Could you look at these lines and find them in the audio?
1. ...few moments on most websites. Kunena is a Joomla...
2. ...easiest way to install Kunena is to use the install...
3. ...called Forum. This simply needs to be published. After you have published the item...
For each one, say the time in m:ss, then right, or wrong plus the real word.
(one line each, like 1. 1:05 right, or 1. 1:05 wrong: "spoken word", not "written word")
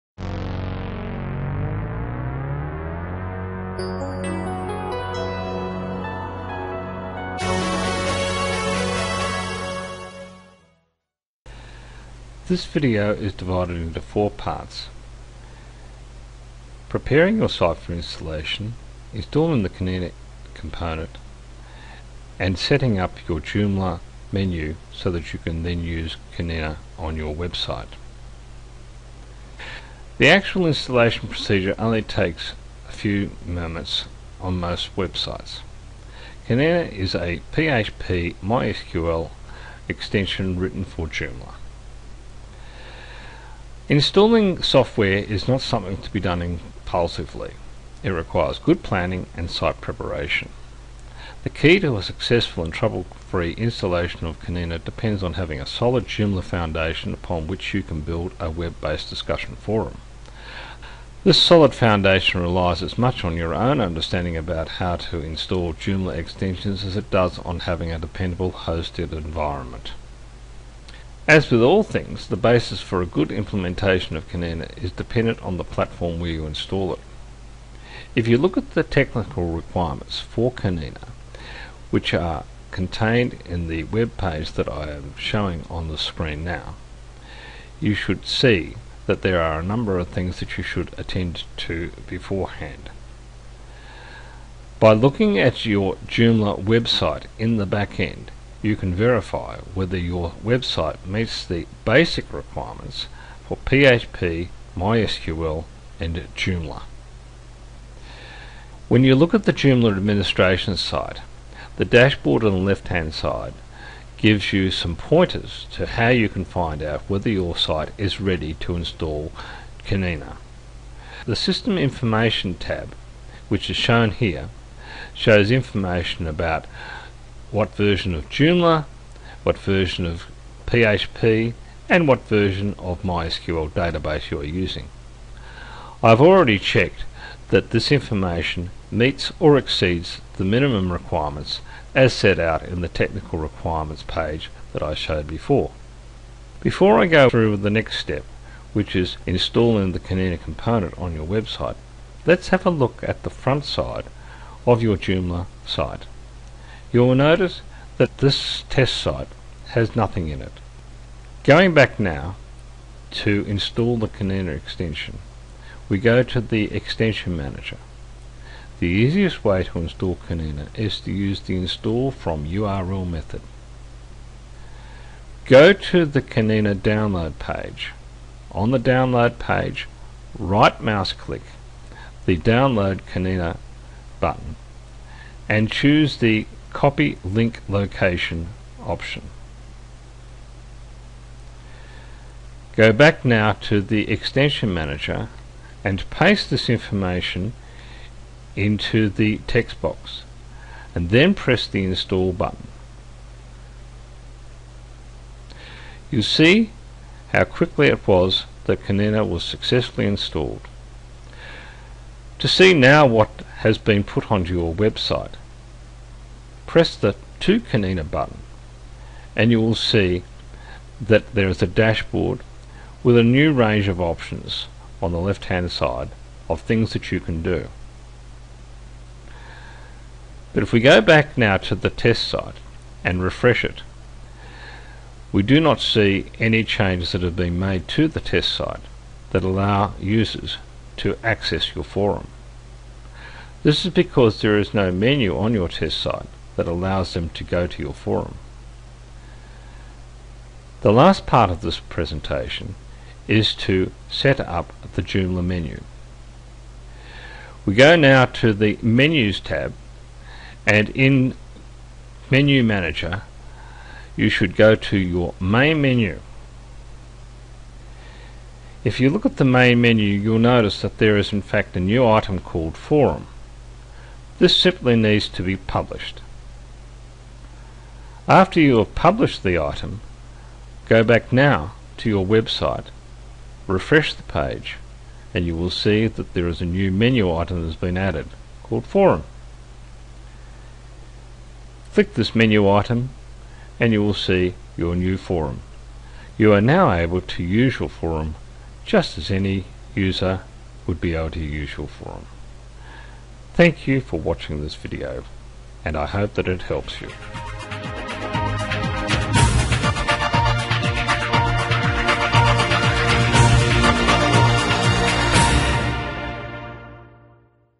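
1. 0:33 wrong: "PHP", not "Joomla"
2. 2:48 right
3. 4:32 right.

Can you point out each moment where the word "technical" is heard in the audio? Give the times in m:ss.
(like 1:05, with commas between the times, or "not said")
1:18, 2:22.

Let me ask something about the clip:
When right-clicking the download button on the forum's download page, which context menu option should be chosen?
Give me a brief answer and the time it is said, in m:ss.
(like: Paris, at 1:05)
Copy link location, at 3:06.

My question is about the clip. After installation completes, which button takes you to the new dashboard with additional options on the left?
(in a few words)
To Kunena.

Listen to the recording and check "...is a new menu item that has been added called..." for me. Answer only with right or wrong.
right.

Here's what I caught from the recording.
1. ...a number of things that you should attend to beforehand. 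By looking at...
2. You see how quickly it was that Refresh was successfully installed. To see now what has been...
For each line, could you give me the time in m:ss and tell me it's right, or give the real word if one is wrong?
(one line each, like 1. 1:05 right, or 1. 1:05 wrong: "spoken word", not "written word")
1. 1:29 right
2. 3:26 wrong: "Kunena", not "Refresh".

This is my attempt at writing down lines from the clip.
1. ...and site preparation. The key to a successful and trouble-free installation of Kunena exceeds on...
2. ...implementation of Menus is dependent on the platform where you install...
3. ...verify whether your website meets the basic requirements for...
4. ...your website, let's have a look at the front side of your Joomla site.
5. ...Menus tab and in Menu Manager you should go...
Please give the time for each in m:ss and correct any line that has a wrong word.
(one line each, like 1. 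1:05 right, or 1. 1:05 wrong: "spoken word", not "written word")
1. 0:49 wrong: "depends", not "exceeds"
2. 1:13 wrong: "Kunena", not "Menus"
3. 1:38 right
4. 2:31 right
5. 4:18 right.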